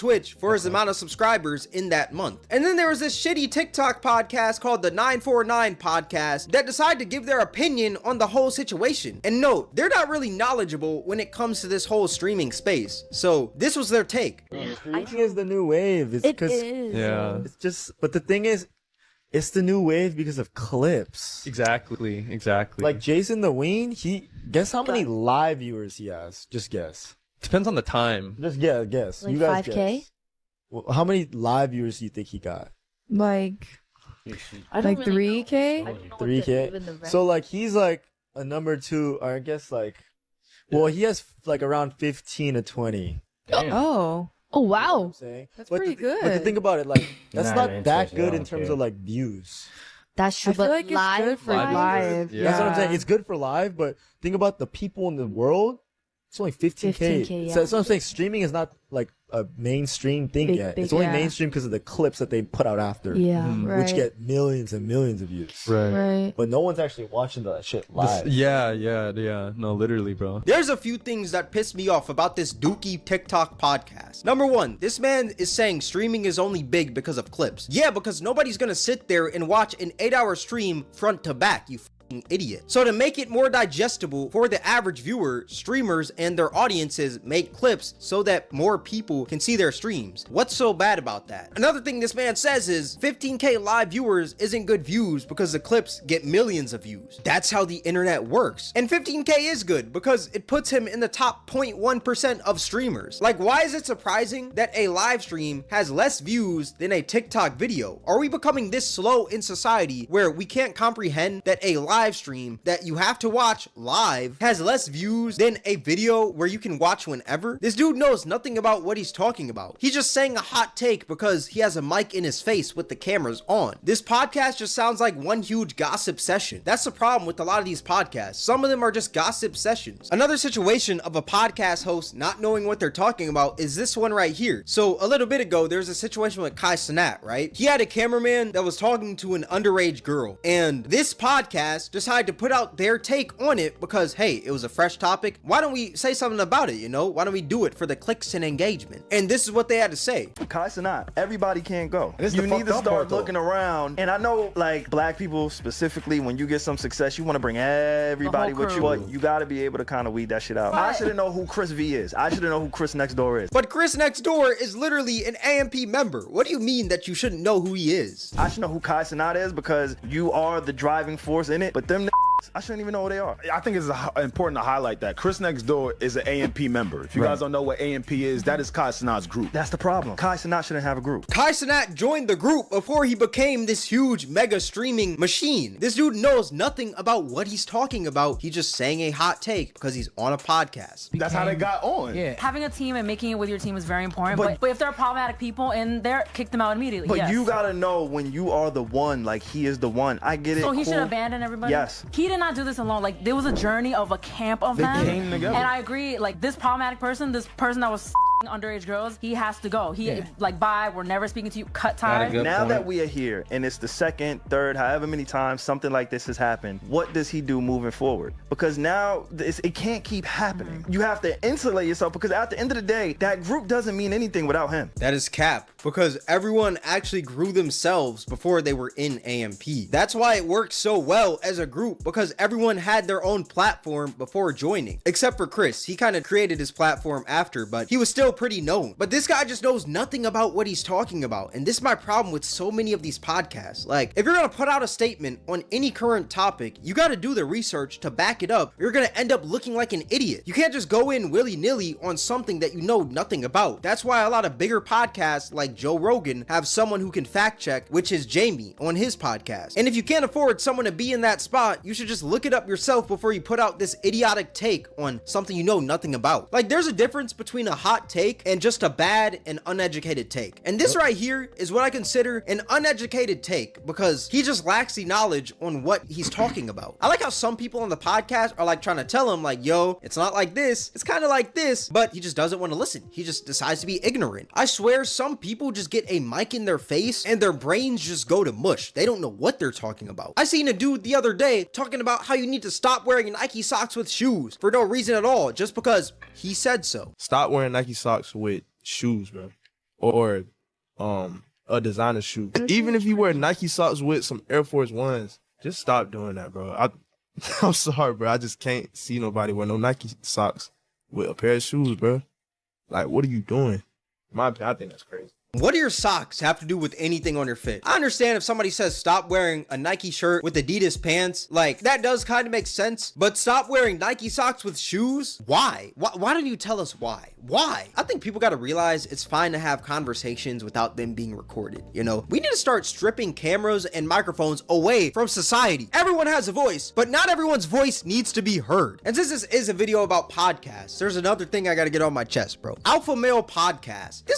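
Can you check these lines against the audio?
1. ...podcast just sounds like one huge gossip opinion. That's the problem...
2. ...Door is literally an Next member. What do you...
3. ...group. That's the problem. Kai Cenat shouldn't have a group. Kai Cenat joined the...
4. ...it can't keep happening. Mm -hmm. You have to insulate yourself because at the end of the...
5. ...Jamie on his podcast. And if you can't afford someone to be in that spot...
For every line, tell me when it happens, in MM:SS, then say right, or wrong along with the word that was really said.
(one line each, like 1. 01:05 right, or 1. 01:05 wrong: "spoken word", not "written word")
1. 02:04 wrong: "session", not "opinion"
2. 02:44 wrong: "AMP", not "Next"
3. 02:59 right
4. 03:39 right
5. 04:18 right.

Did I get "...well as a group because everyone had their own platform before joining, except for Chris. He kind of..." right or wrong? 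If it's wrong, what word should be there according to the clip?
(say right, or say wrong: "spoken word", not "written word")
right.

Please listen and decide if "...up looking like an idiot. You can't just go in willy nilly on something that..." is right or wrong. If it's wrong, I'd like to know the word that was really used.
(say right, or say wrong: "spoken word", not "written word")
right.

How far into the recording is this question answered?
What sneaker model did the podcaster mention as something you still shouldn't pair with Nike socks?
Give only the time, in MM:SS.
05:04.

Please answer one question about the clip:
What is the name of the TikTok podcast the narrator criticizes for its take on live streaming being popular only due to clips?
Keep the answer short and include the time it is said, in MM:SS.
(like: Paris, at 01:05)
949 podcast, at 00:04.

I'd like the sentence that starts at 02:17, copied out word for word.
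He had a cameraman that was talking to an underage girl.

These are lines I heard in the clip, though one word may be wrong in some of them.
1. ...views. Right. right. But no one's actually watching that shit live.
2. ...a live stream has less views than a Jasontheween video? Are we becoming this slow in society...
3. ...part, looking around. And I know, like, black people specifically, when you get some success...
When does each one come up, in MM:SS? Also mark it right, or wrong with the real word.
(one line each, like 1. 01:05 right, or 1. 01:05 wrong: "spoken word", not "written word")
1. 01:05 right
2. 01:44 wrong: "TikTok", not "Jasontheween"
3. 02:32 right.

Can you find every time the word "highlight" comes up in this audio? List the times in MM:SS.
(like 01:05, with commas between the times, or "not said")
02:54.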